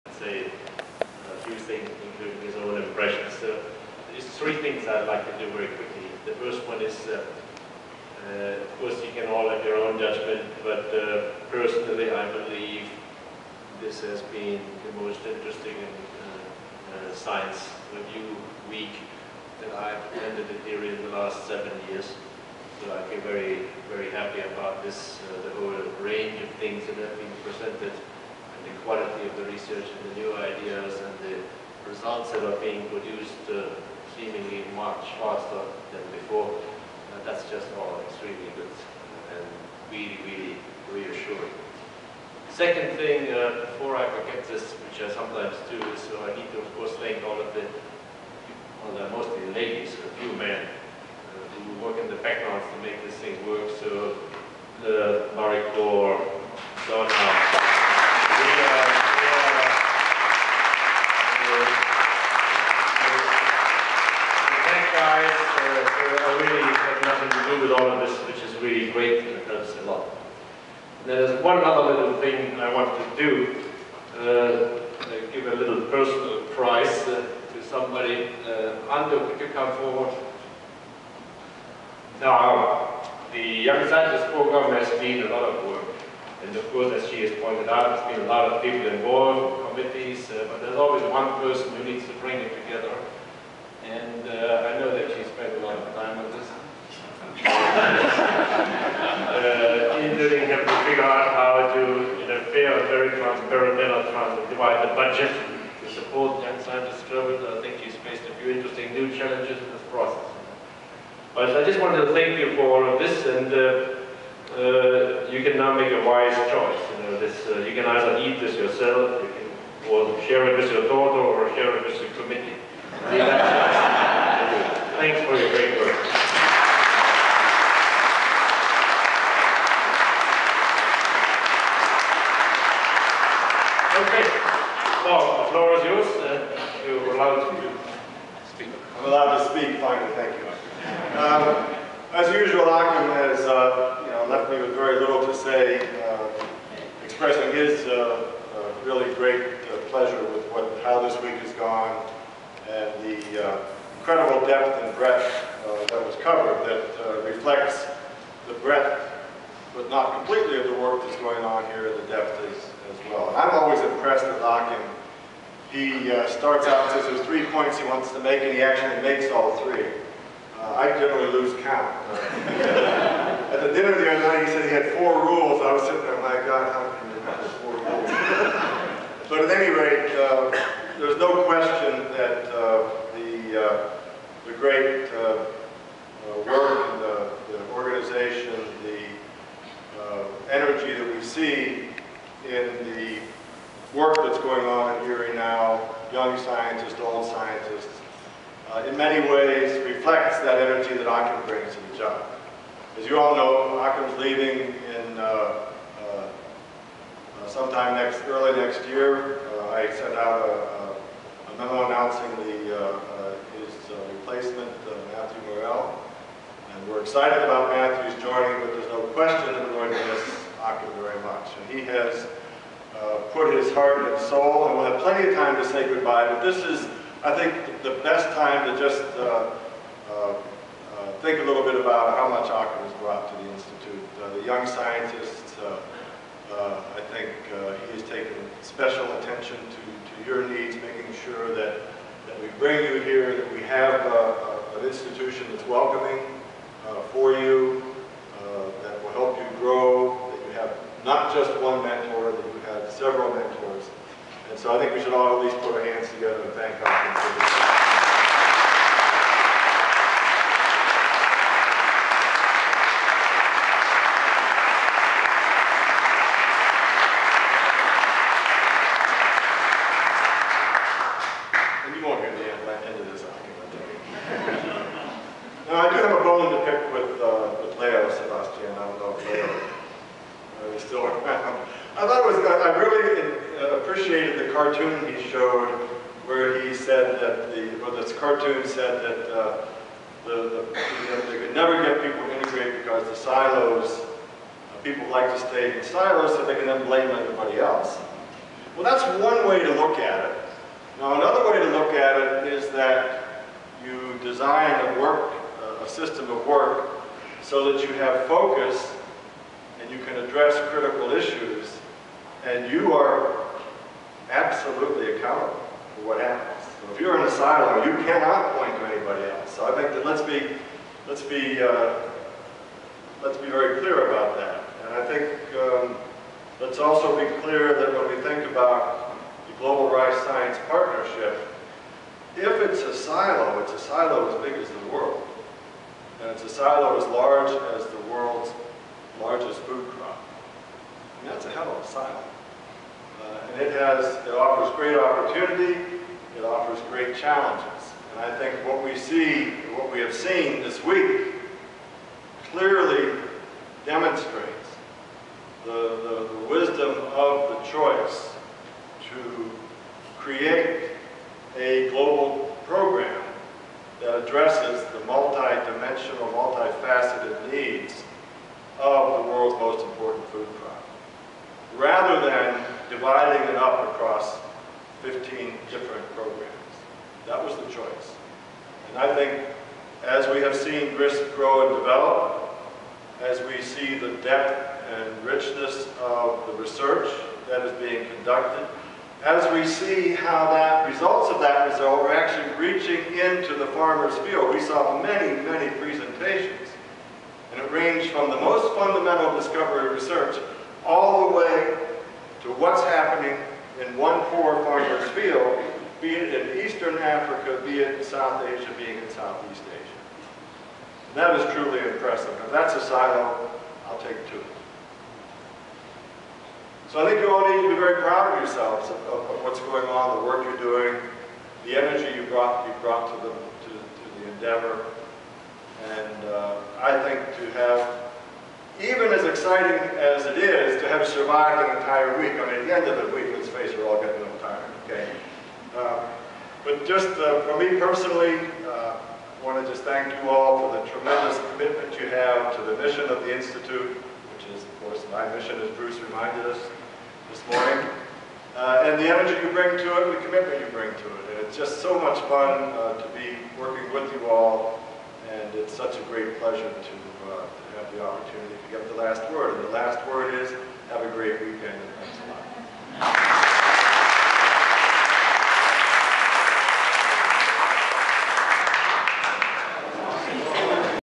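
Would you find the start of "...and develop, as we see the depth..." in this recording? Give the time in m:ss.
6:21.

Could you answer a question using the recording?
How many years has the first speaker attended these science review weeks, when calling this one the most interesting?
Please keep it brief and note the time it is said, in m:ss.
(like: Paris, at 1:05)
7, at 0:21.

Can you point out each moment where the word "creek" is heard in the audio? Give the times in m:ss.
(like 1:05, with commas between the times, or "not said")
not said.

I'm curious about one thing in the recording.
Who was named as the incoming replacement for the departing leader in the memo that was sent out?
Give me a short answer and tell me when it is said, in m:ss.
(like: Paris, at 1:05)
Matthew Morell, at 3:35.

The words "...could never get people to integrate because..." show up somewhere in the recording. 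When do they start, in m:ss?
4:51.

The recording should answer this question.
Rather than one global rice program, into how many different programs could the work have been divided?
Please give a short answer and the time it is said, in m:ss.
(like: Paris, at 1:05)
15, at 6:15.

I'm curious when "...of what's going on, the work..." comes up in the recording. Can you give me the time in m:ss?
6:59.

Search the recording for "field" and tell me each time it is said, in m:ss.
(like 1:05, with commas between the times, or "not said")
6:34, 6:45.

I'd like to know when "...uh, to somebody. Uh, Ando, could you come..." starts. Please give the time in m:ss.
1:17.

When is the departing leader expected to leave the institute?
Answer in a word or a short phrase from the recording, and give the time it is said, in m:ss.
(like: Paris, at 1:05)
early next year, at 3:28.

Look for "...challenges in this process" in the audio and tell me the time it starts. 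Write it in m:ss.
1:49.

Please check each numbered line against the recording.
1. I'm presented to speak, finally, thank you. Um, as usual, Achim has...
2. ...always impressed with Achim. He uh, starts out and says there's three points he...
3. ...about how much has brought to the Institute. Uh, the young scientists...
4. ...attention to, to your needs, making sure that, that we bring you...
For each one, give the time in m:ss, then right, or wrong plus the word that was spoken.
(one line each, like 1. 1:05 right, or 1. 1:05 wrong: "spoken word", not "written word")
1. 2:18 wrong: "allowed", not "presented"
2. 2:43 right
3. 3:51 right
4. 3:59 right.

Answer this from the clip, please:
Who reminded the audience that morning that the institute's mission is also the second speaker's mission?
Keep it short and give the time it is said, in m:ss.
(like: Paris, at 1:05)
Bruce, at 7:25.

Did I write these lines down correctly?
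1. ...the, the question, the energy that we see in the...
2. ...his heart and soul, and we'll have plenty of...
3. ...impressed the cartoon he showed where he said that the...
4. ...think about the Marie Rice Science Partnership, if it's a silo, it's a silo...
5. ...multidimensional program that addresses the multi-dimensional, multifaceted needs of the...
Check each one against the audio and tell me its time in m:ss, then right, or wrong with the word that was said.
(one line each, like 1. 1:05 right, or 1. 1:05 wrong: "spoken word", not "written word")
1. 3:07 wrong: "organization", not "question"
2. 3:43 right
3. 4:43 wrong: "appreciated", not "impressed"
4. 5:28 wrong: "Global", not "Marie"
5. 6:01 wrong: "global", not "multidimensional".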